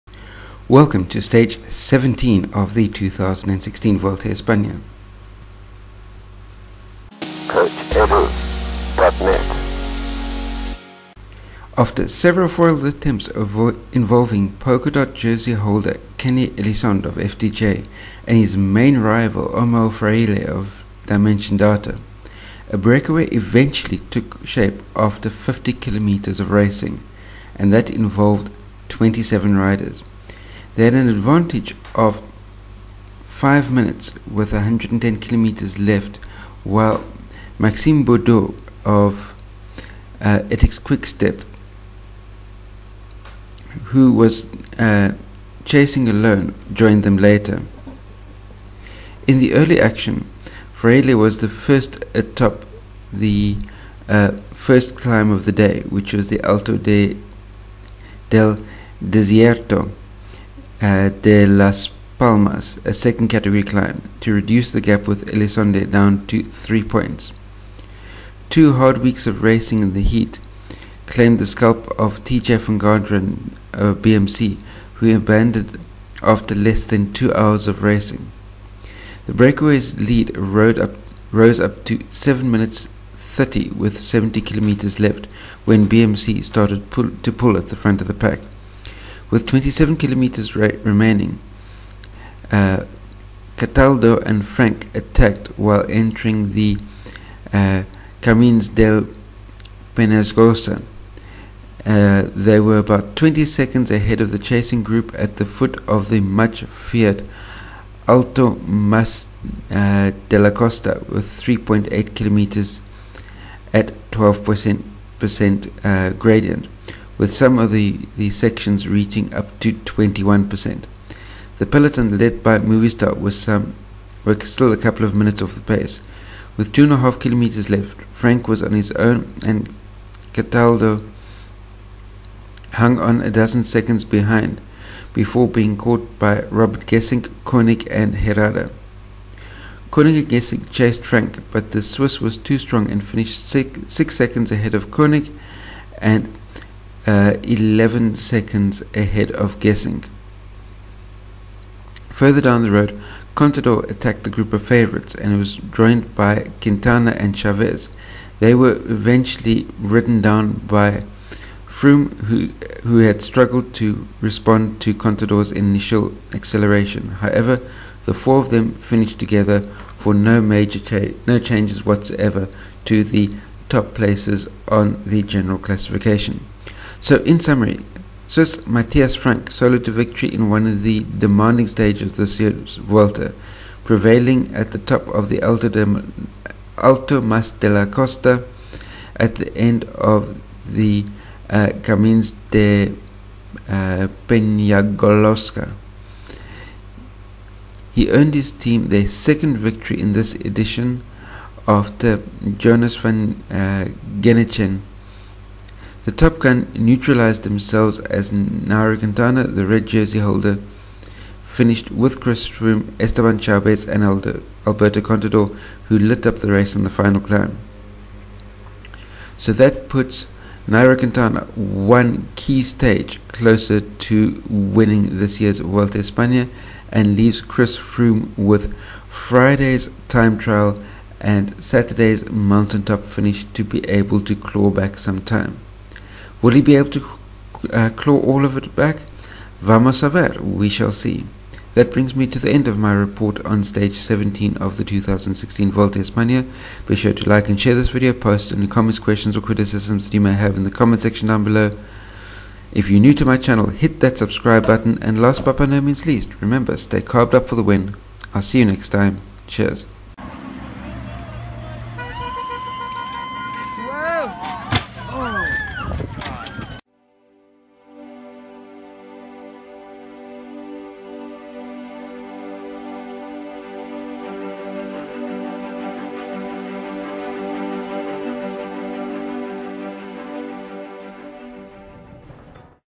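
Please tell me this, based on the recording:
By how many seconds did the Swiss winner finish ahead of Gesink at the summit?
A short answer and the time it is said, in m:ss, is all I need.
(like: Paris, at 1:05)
11, at 2:27.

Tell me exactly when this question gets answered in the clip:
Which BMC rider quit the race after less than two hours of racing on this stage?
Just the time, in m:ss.
1:12.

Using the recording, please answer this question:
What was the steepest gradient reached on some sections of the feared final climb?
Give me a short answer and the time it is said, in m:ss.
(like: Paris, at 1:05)
21%, at 1:59.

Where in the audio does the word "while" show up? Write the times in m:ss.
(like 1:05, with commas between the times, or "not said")
0:36, 1:35.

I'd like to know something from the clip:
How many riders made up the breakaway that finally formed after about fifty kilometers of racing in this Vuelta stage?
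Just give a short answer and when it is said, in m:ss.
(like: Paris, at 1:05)
27, at 0:28.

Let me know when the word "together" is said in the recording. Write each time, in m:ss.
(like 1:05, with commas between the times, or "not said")
2:49.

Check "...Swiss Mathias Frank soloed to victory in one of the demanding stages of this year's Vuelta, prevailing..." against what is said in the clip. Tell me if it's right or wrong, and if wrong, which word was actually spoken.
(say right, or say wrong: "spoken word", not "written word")
right.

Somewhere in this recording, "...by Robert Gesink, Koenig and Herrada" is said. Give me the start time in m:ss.
2:16.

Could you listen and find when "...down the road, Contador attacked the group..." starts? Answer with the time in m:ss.
2:32.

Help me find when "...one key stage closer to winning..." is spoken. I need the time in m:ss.
3:41.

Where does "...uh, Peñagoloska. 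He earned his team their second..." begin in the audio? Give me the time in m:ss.
3:12.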